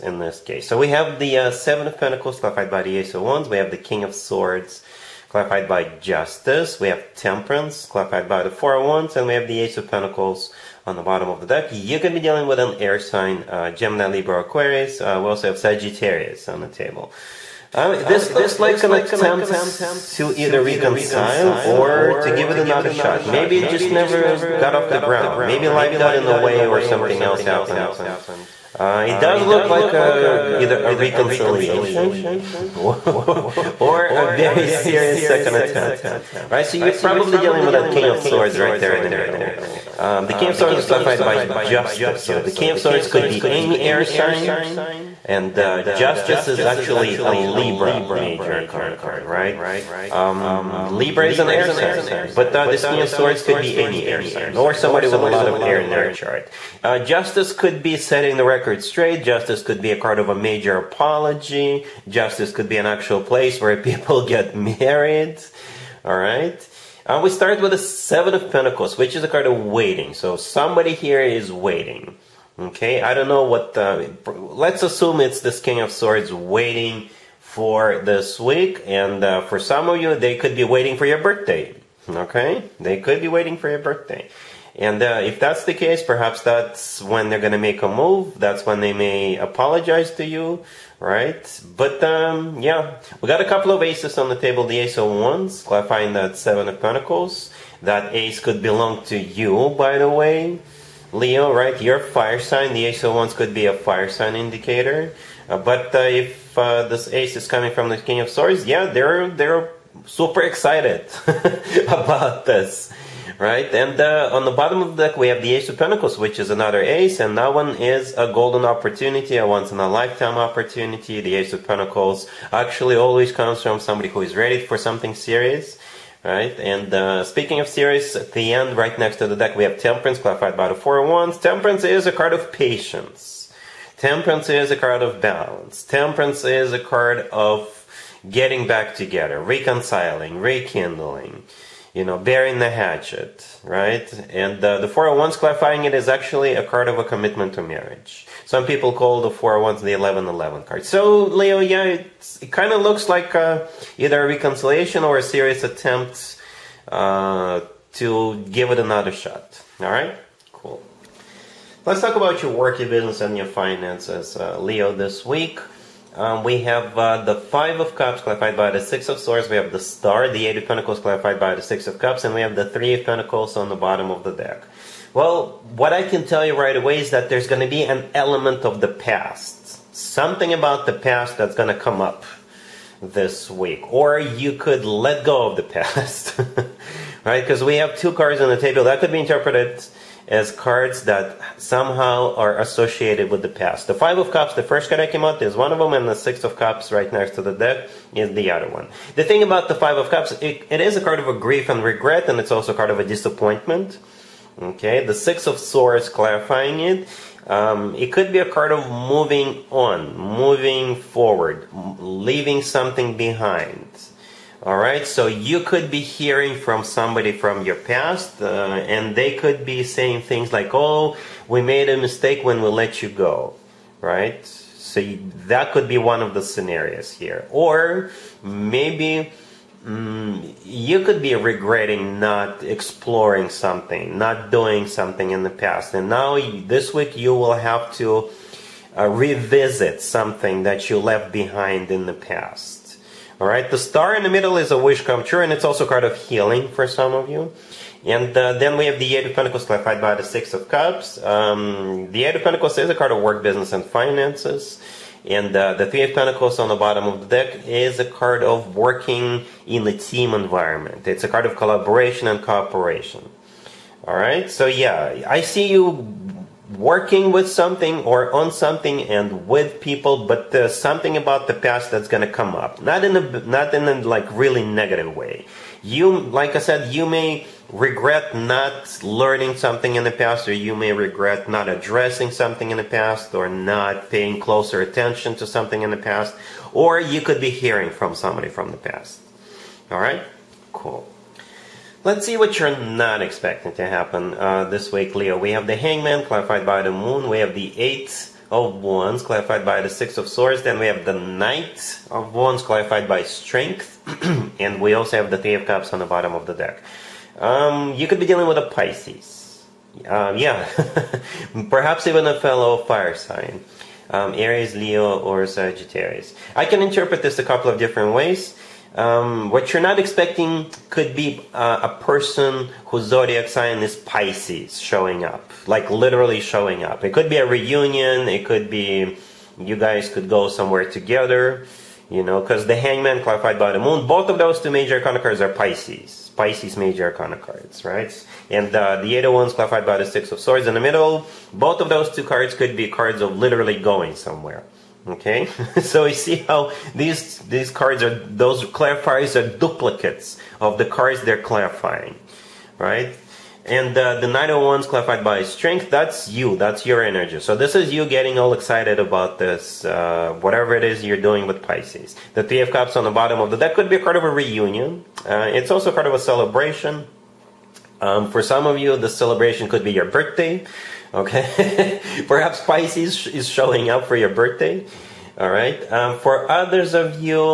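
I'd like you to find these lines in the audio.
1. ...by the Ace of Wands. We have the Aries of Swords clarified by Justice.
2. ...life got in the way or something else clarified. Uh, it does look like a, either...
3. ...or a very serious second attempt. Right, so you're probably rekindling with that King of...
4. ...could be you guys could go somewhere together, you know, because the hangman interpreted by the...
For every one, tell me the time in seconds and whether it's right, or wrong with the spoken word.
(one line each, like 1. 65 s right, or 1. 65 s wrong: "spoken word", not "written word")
1. 2 s wrong: "King", not "Aries"
2. 25 s wrong: "happened", not "clarified"
3. 33 s wrong: "dealing", not "rekindling"
4. 328 s wrong: "clarified", not "interpreted".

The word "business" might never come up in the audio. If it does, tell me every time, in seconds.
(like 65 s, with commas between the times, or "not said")
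162 s, 253 s.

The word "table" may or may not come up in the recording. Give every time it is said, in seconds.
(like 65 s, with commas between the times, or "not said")
16 s, 94 s, 188 s.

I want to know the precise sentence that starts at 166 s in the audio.
Um, we have uh, the Five of Cups clarified by the Six of Swords.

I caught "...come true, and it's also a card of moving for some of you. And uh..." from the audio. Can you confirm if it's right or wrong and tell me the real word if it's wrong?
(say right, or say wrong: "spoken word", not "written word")
wrong: "healing", not "moving".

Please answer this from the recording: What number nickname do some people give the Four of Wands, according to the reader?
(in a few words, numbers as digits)
1111.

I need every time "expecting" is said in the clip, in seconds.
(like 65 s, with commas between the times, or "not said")
293 s, 319 s.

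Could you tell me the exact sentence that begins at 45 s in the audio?
And uh, Justice is actually a Libra major arcana card, right?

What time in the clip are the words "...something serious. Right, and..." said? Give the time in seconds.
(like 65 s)
124 s.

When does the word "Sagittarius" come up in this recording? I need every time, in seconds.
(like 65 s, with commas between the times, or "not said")
15 s, 315 s.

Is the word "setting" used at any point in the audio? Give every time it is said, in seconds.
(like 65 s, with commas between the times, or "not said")
57 s.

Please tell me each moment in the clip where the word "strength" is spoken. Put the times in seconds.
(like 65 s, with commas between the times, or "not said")
303 s, 355 s.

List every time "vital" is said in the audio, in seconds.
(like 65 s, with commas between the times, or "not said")
not said.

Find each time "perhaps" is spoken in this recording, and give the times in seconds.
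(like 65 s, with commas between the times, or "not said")
86 s, 311 s, 372 s.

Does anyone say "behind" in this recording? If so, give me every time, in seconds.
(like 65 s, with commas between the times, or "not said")
213 s, 241 s.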